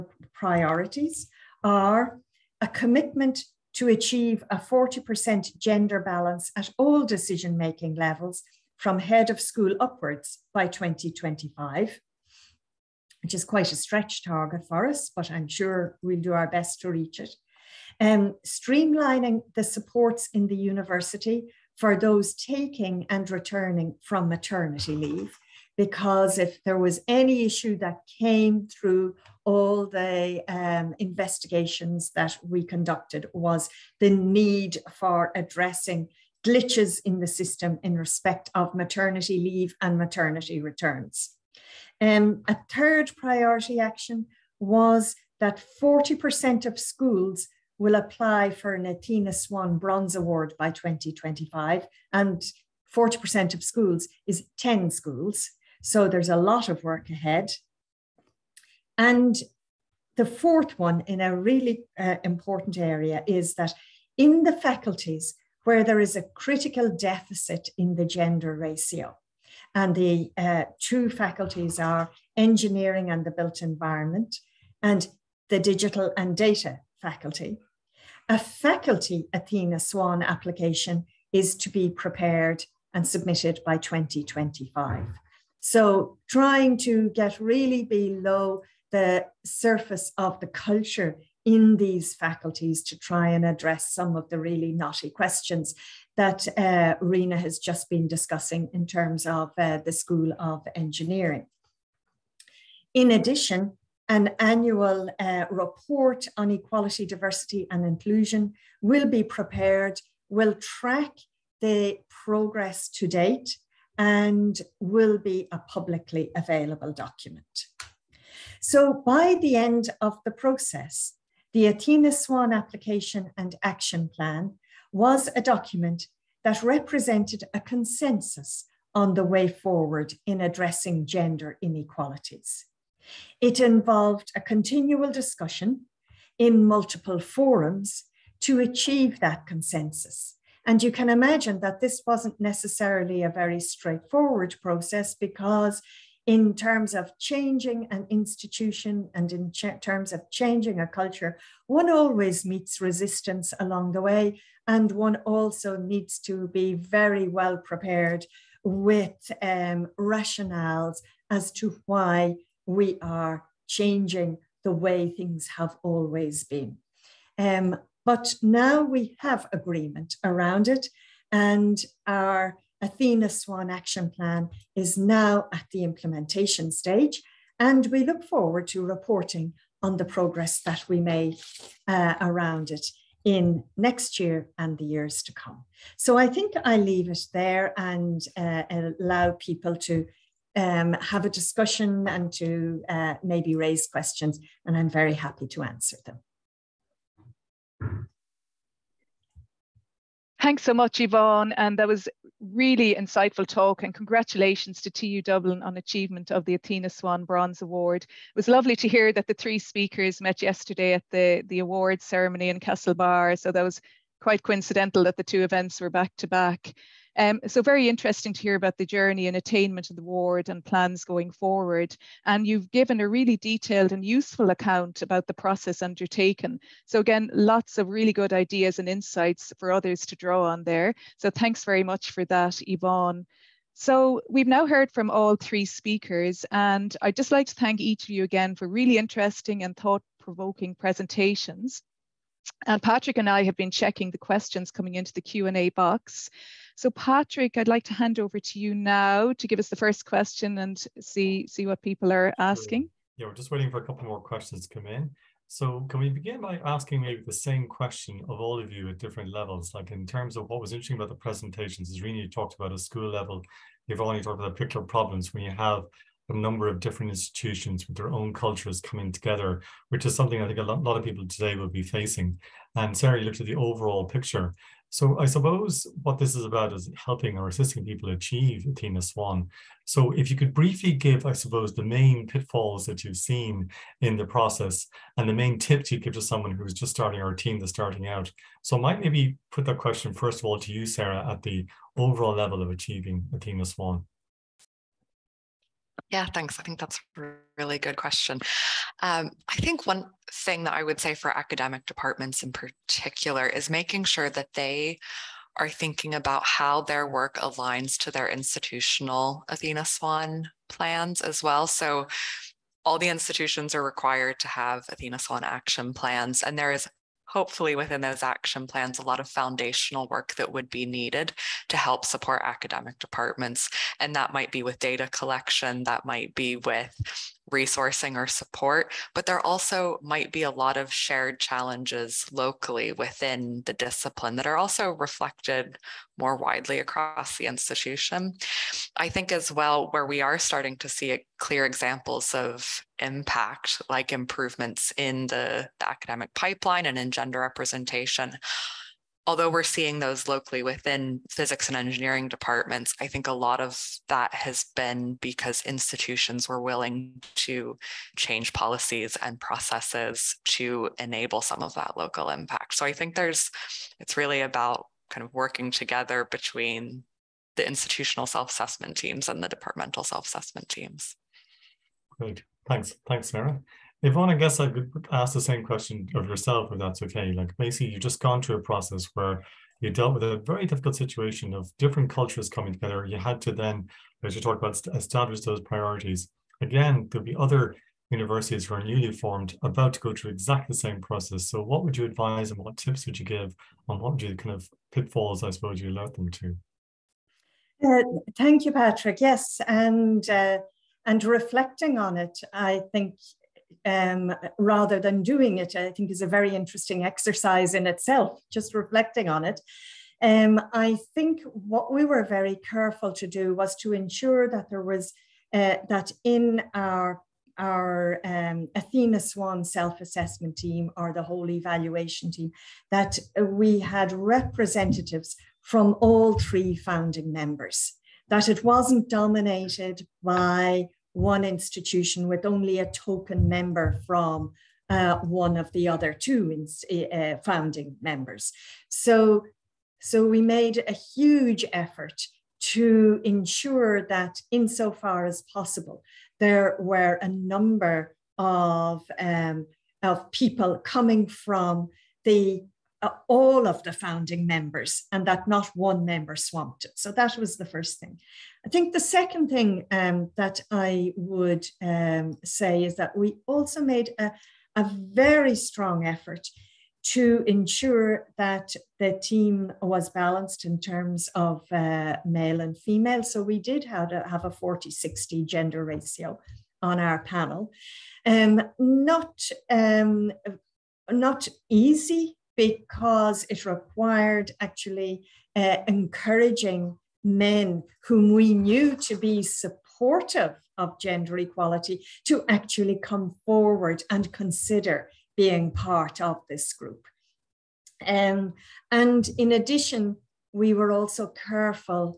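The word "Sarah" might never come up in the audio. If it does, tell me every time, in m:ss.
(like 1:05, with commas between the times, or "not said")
4:32, 4:50, 6:13.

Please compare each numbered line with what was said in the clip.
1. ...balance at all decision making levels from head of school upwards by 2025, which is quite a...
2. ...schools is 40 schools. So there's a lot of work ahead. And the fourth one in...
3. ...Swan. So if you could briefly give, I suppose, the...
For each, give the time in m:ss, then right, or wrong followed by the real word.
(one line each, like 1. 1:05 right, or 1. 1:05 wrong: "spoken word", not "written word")
1. 0:06 right
2. 0:53 wrong: "10", not "40"
3. 4:39 right.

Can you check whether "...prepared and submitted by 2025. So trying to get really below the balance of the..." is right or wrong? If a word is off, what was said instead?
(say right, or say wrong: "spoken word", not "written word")
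wrong: "surface", not "balance".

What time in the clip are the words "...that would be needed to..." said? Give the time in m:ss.
5:20.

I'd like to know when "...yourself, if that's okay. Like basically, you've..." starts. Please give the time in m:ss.
6:16.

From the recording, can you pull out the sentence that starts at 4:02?
And uh, Patrick and I have been checking the questions coming into the Q&A box.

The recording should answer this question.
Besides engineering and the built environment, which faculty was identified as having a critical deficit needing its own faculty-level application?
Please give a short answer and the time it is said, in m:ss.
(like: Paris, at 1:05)
Digital and data faculty, at 1:15.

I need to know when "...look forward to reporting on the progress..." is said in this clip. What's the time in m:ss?
2:58.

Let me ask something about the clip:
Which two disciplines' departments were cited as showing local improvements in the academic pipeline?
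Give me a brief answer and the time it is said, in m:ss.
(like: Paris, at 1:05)
Physics and engineering, at 5:51.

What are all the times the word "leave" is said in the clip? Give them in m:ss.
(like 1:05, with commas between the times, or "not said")
0:24, 0:39, 3:06.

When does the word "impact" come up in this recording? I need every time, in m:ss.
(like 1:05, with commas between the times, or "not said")
5:42, 6:02.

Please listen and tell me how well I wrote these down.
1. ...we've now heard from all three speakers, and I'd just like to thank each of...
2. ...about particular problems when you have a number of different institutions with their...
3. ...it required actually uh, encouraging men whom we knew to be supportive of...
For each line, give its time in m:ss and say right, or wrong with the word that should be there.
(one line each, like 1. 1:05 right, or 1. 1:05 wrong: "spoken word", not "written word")
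1. 3:54 right
2. 4:24 right
3. 8:03 right.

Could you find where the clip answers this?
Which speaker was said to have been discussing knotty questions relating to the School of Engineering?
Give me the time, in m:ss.
1:37.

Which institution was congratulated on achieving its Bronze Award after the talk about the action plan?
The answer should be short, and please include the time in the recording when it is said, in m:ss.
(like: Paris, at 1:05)
TU Dublin, at 3:24.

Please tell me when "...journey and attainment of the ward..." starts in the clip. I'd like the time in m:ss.
3:38.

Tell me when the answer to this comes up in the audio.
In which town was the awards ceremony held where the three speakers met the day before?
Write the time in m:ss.
3:32.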